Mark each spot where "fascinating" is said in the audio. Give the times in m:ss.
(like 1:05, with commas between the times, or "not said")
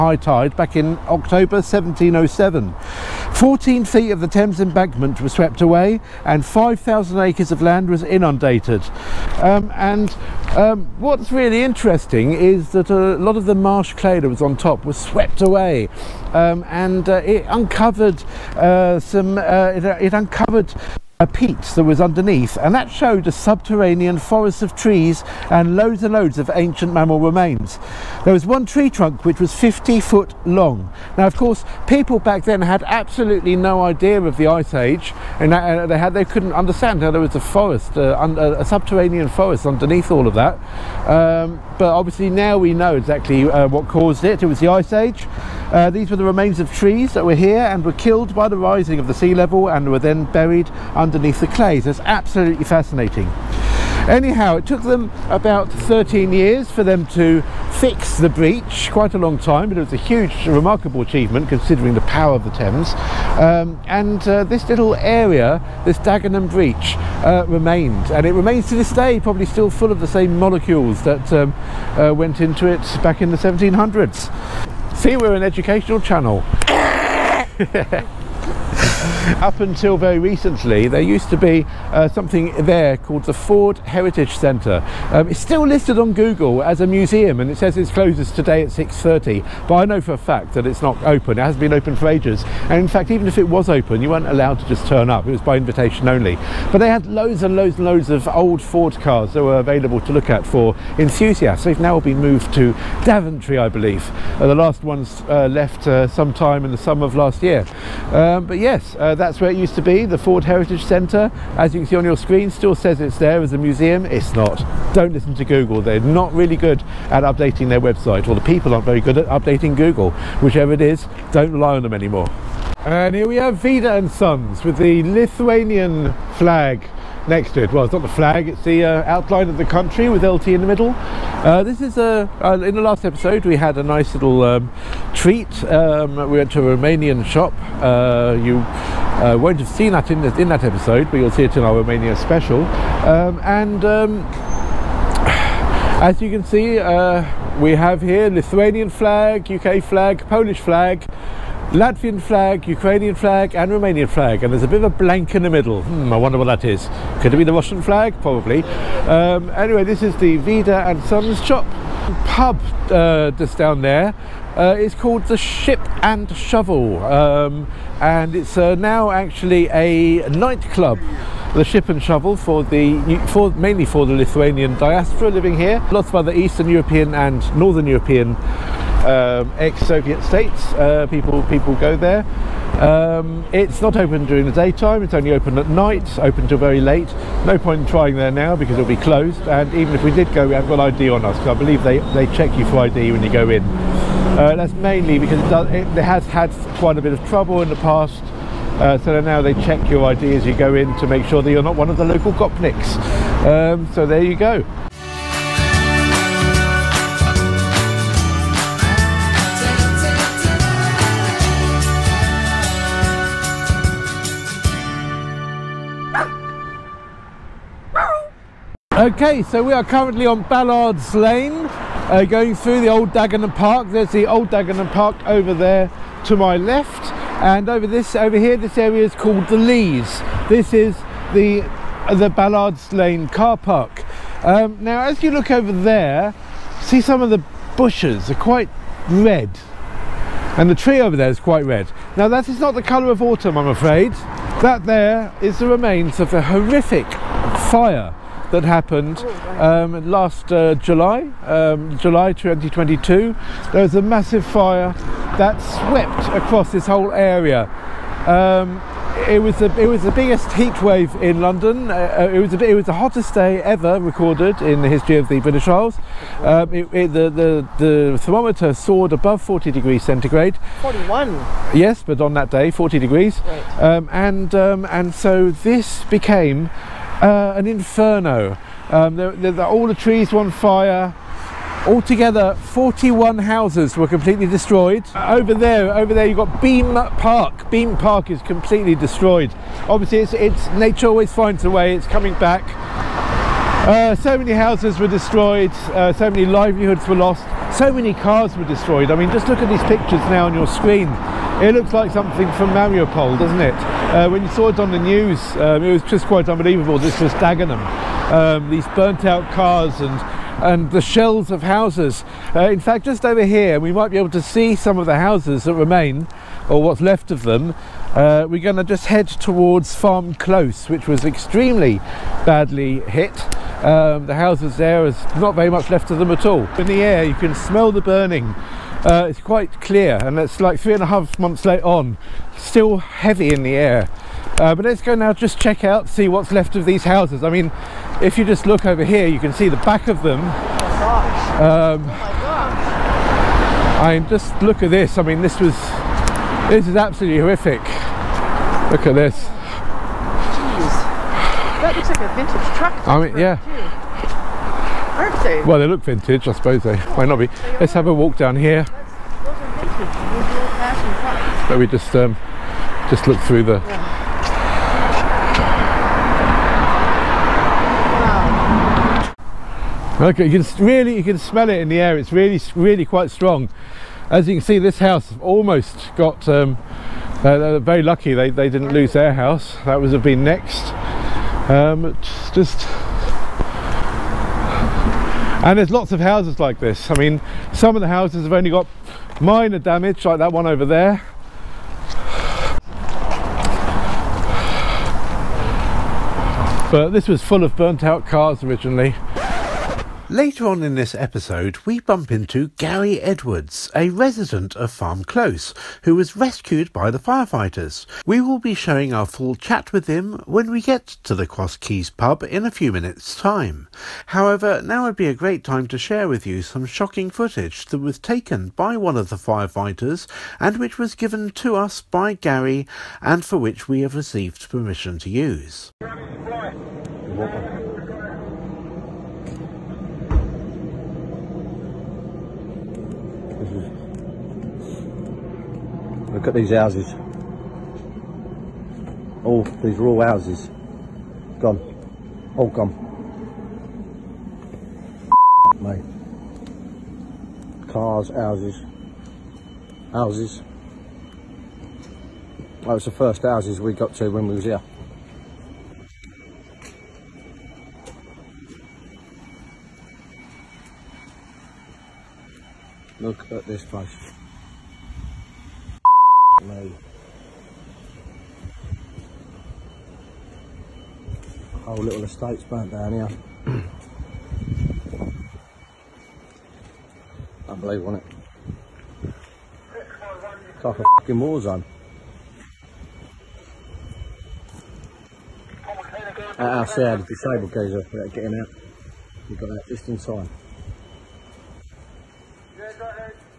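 0:52.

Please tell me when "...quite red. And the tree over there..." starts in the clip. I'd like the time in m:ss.
3:58.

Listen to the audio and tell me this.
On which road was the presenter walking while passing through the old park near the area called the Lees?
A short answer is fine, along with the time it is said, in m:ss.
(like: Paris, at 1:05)
Ballard's Lane, at 3:40.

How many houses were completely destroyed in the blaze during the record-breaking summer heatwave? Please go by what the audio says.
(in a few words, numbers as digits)
41.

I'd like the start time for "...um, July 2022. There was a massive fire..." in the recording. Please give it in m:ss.
4:11.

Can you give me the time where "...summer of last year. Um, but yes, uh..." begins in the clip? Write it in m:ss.
1:46.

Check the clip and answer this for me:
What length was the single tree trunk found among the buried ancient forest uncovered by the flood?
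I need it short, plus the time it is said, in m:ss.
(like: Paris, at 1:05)
50 feet, at 0:29.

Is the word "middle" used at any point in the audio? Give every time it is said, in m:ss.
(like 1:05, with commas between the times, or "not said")
2:10, 2:35.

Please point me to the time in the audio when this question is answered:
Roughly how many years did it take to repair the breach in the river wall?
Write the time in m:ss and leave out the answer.
0:55.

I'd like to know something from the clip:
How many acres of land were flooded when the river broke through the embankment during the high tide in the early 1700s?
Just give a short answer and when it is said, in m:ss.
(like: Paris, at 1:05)
5,000, at 0:06.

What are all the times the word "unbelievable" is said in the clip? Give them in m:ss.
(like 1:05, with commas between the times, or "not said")
5:06, 7:57.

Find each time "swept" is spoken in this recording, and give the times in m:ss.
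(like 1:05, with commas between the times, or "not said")
0:05, 0:14, 4:15.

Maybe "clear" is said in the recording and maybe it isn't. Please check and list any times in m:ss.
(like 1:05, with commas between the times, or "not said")
5:29.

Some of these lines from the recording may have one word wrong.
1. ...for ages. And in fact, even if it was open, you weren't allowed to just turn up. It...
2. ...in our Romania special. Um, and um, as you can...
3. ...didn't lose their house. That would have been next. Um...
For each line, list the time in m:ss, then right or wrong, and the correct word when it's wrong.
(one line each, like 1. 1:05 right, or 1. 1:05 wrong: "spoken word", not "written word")
1. 1:31 right
2. 2:21 right
3. 6:18 right.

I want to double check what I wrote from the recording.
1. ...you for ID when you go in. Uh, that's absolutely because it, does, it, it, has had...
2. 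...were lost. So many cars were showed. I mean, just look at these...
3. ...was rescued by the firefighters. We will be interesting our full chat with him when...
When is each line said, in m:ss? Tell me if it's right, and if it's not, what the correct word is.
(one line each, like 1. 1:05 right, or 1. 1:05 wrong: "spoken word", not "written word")
1. 3:12 wrong: "mainly", not "absolutely"
2. 4:57 wrong: "destroyed", not "showed"
3. 6:46 wrong: "showing", not "interesting".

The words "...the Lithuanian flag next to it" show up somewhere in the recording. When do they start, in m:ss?
2:04.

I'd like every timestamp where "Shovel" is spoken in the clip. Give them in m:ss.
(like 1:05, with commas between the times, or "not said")
2:46, 2:52.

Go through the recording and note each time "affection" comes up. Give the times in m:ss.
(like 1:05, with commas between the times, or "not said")
not said.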